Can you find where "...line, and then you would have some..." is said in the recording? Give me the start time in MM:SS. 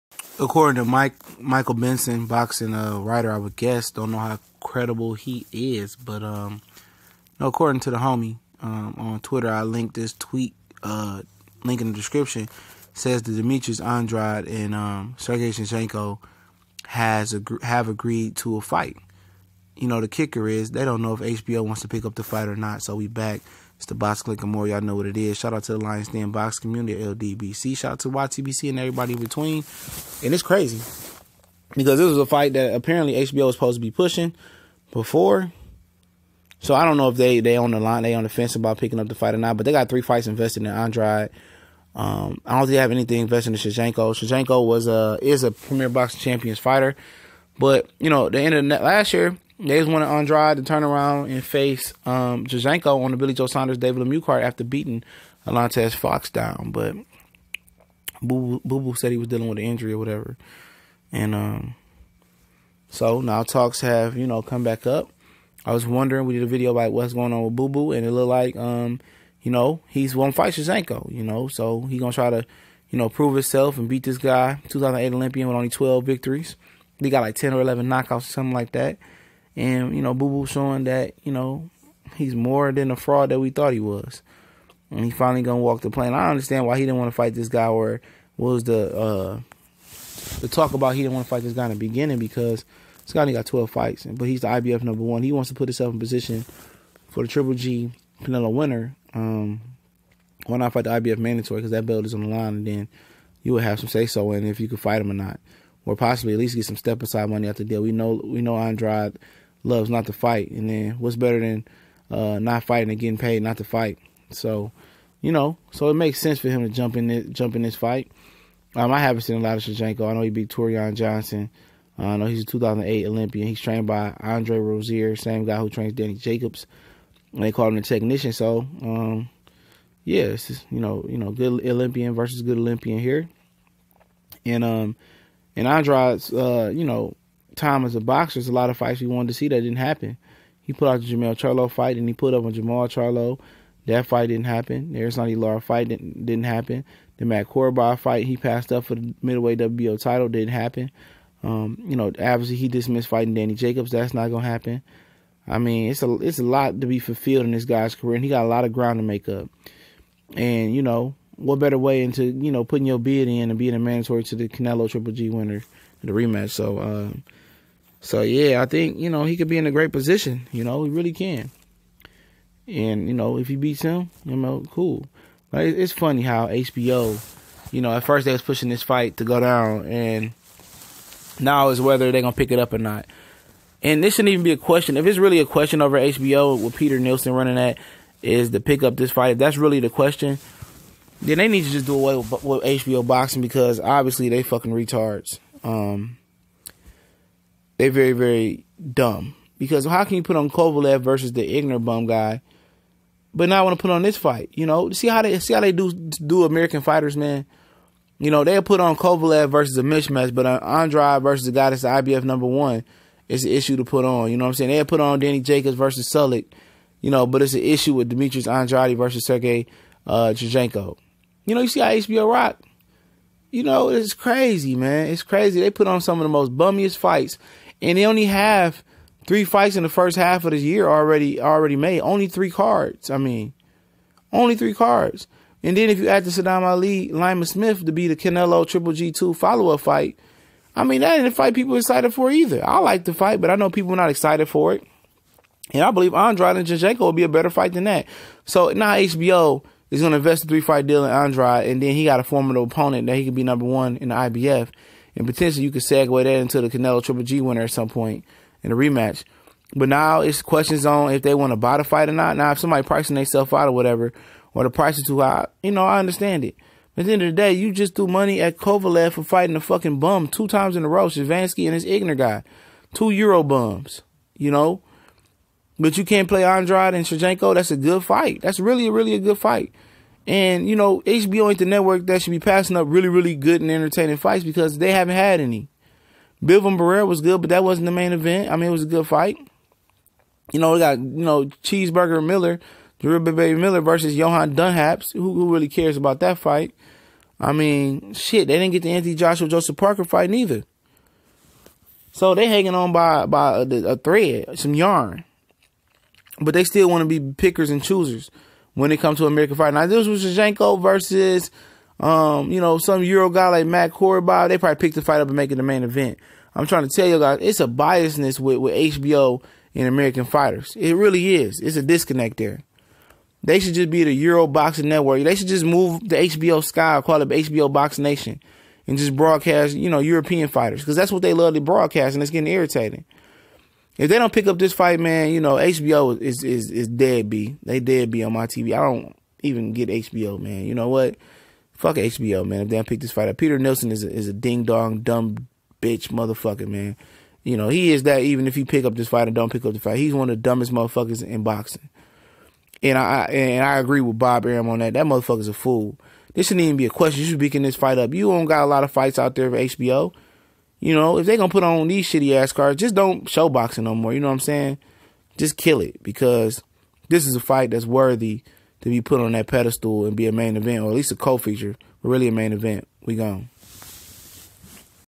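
01:42.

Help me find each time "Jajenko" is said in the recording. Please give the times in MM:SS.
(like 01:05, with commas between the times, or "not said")
03:40, 04:06.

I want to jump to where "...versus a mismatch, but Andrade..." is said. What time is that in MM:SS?
03:29.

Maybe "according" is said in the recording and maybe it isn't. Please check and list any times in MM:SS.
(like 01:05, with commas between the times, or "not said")
00:00, 00:07.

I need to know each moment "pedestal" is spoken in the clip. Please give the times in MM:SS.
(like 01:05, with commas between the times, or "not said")
06:09.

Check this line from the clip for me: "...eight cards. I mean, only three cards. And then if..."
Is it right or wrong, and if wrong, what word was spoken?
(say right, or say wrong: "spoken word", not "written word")
wrong: "three", not "eight".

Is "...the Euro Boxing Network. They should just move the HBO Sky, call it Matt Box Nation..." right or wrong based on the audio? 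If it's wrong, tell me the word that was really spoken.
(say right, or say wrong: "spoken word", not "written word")
wrong: "HBO", not "Matt".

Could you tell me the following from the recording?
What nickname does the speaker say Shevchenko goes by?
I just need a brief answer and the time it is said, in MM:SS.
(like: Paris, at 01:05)
the technician, at 02:07.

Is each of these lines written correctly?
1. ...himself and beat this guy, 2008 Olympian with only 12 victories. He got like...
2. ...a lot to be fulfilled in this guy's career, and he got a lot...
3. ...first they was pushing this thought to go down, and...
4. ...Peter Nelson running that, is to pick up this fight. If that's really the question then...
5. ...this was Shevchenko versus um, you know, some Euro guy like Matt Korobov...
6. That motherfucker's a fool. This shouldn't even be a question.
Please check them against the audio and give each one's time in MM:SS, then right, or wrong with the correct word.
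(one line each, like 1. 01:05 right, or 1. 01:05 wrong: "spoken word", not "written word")
1. 01:13 right
2. 02:36 right
3. 02:58 wrong: "fight", not "thought"
4. 03:06 right
5. 05:09 right
6. 05:54 right.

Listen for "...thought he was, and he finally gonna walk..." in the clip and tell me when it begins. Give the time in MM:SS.
01:23.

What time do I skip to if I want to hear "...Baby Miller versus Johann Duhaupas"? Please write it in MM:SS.
04:53.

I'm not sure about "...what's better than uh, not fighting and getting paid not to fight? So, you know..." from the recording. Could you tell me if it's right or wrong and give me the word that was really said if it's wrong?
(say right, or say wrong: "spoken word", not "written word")
right.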